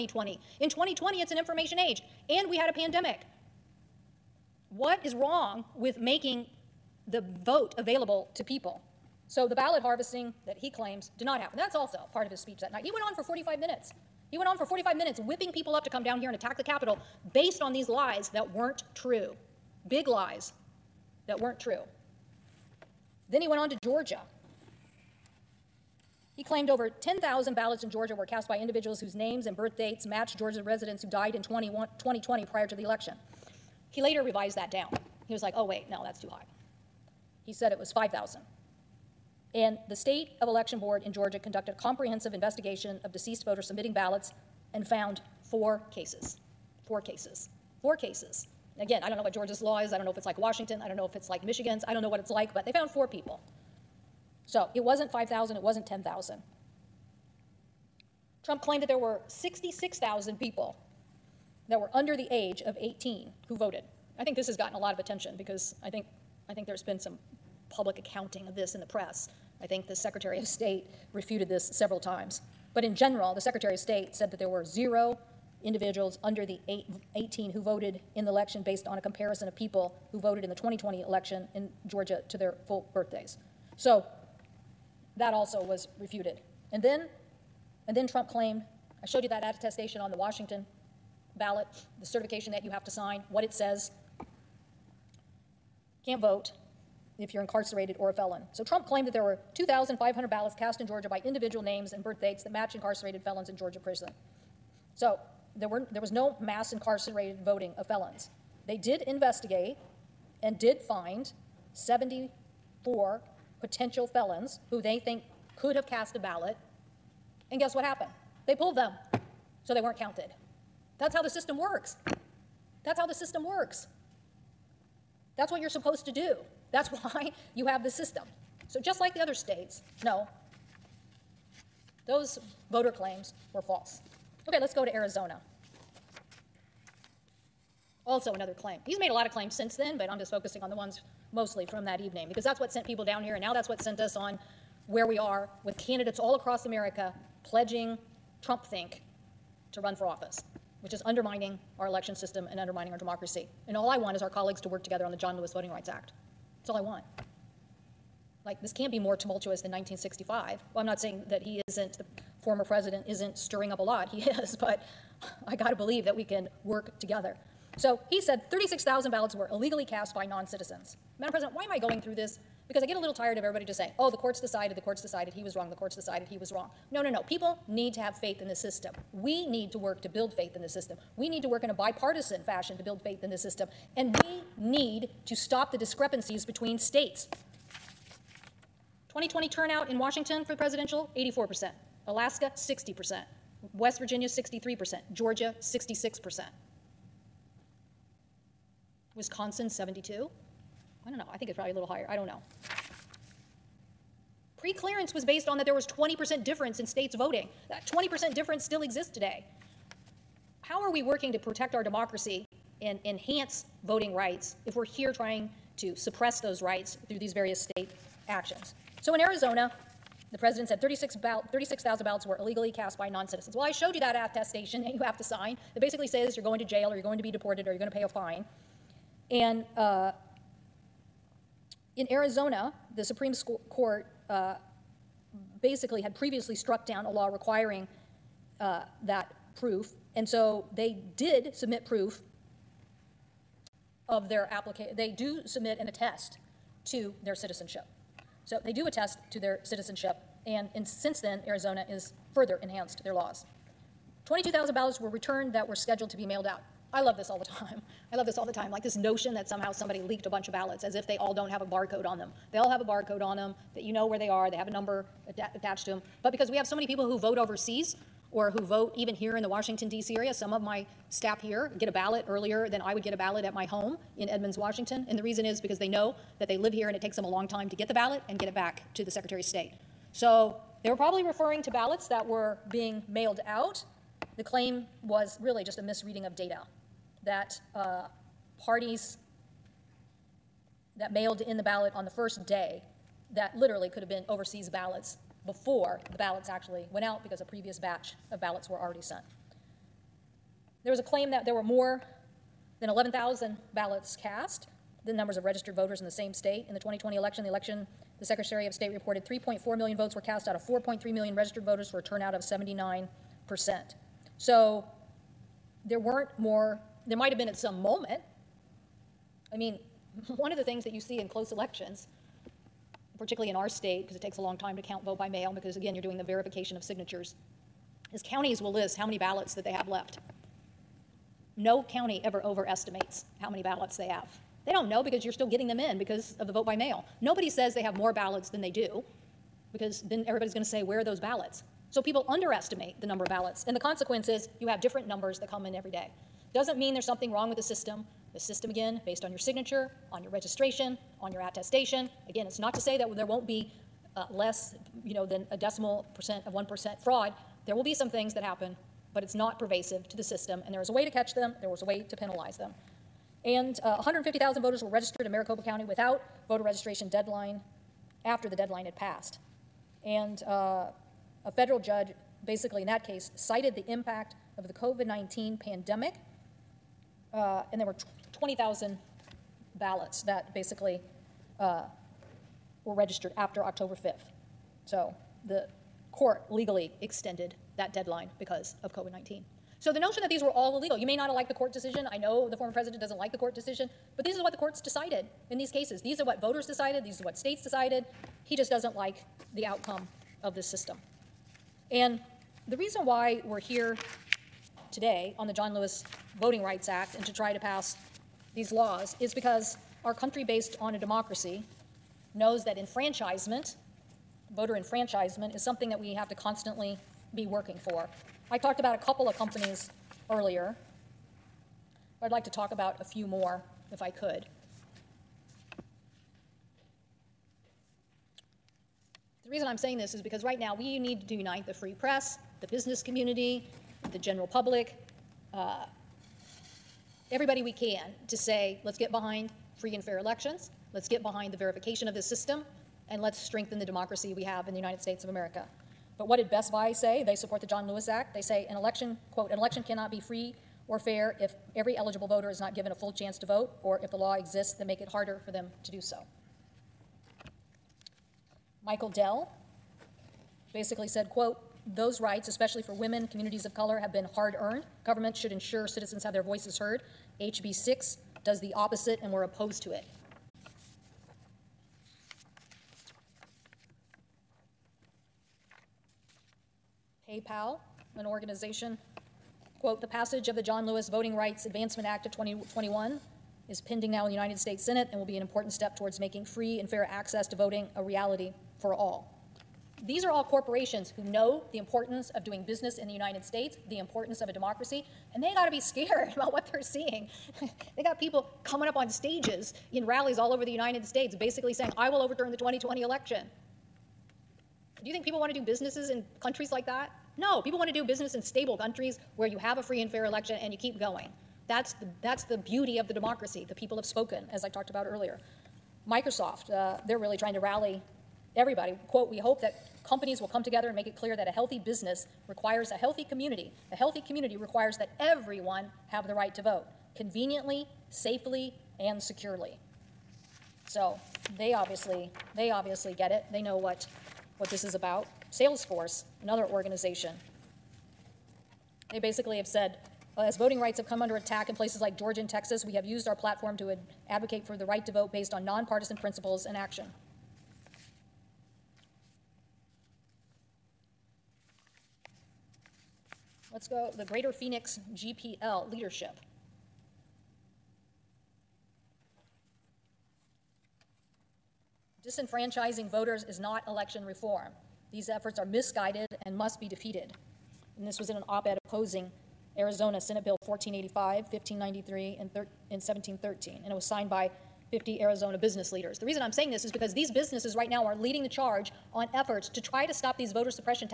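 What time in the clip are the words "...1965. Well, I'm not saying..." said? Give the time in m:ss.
2:39.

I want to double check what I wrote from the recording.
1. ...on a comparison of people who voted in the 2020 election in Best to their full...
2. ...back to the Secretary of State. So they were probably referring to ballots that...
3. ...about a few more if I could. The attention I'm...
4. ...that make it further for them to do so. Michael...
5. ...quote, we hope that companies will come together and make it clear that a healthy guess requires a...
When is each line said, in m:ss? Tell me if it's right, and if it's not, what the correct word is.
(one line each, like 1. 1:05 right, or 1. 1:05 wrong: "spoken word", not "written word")
1. 1:18 wrong: "Georgia", not "Best"
2. 4:38 right
3. 7:02 wrong: "reason", not "attention"
4. 7:34 wrong: "harder", not "further"
5. 8:39 wrong: "business", not "guess".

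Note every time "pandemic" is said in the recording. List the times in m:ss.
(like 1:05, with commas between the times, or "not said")
0:02, 6:15.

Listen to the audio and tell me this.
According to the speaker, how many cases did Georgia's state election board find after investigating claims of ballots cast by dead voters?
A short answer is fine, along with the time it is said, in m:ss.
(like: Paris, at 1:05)
4, at 0:44.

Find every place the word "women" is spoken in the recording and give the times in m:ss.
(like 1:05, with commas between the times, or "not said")
7:42.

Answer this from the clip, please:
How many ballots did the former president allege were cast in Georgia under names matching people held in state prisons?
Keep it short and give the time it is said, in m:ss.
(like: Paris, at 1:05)
2,500, at 1:39.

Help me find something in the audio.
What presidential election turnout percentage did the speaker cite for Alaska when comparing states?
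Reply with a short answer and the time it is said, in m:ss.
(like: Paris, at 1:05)
60%, at 3:12.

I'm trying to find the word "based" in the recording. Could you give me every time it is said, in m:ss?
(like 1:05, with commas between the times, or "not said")
0:17, 1:18, 3:25, 5:49, 6:50, 9:05.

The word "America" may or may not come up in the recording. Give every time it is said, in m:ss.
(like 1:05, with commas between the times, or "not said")
2:26, 7:25.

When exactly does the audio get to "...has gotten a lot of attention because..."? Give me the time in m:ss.
1:04.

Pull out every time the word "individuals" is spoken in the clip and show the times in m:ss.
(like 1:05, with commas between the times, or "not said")
0:28, 1:15, 1:41.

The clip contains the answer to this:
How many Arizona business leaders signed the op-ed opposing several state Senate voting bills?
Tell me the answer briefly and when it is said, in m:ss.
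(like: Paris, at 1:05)
50, at 9:34.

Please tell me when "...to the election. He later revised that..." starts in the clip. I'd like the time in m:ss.
0:32.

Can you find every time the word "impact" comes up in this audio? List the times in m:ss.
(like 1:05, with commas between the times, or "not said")
6:13.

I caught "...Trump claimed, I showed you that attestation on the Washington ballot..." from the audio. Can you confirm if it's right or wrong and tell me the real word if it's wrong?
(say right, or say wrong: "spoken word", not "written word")
right.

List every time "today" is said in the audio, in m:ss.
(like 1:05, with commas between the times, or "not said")
3:29, 6:44.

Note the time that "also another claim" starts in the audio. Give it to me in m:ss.
2:18.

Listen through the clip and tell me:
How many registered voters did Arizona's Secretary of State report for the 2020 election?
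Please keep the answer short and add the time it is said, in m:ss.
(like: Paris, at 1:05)
4.3 million, at 5:10.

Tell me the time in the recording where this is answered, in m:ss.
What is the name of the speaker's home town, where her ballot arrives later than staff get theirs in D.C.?
4:34.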